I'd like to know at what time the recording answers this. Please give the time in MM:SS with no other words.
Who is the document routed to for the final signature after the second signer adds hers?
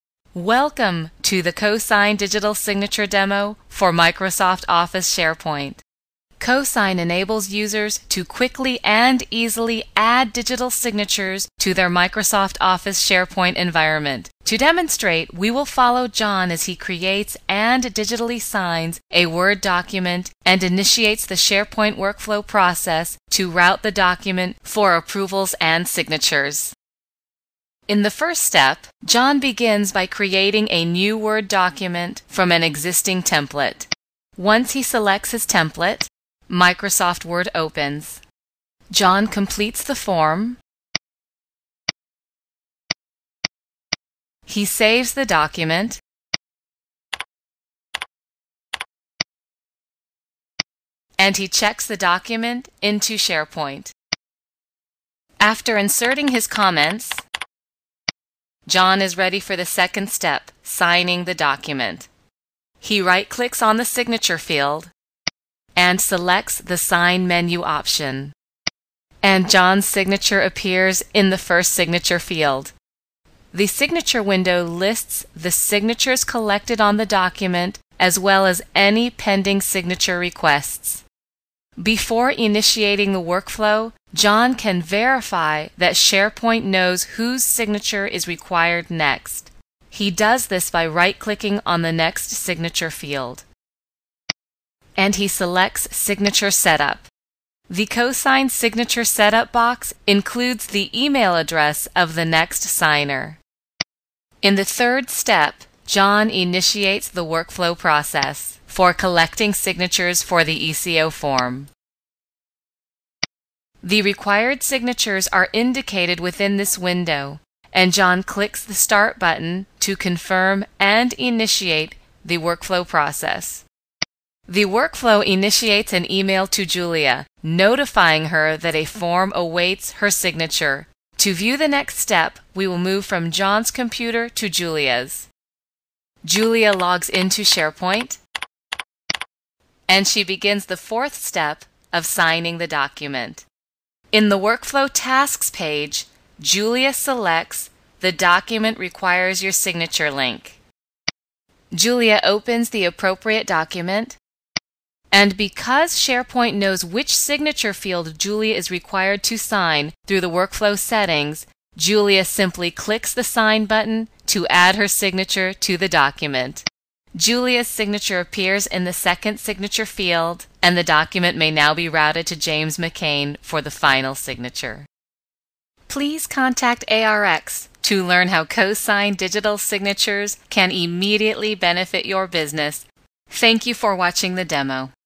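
02:52.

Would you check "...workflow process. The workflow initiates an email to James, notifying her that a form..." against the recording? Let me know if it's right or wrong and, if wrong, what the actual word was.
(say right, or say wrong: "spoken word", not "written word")
wrong: "Julia", not "James".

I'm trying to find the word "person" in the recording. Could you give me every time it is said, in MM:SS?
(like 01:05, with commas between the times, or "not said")
not said.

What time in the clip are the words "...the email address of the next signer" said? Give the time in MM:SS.
01:40.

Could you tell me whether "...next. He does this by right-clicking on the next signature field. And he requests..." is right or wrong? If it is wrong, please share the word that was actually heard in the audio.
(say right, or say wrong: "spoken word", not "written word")
wrong: "selects", not "requests".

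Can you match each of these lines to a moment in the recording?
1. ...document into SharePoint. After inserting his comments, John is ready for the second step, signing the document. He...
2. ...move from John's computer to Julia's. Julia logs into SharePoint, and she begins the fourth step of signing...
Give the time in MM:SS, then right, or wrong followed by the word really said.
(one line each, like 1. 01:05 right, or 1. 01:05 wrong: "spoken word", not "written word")
1. 00:51 right
2. 02:12 right.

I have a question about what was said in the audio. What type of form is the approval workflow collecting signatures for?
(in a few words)
ECO form.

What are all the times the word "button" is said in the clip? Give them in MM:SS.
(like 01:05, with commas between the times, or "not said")
01:59, 02:43.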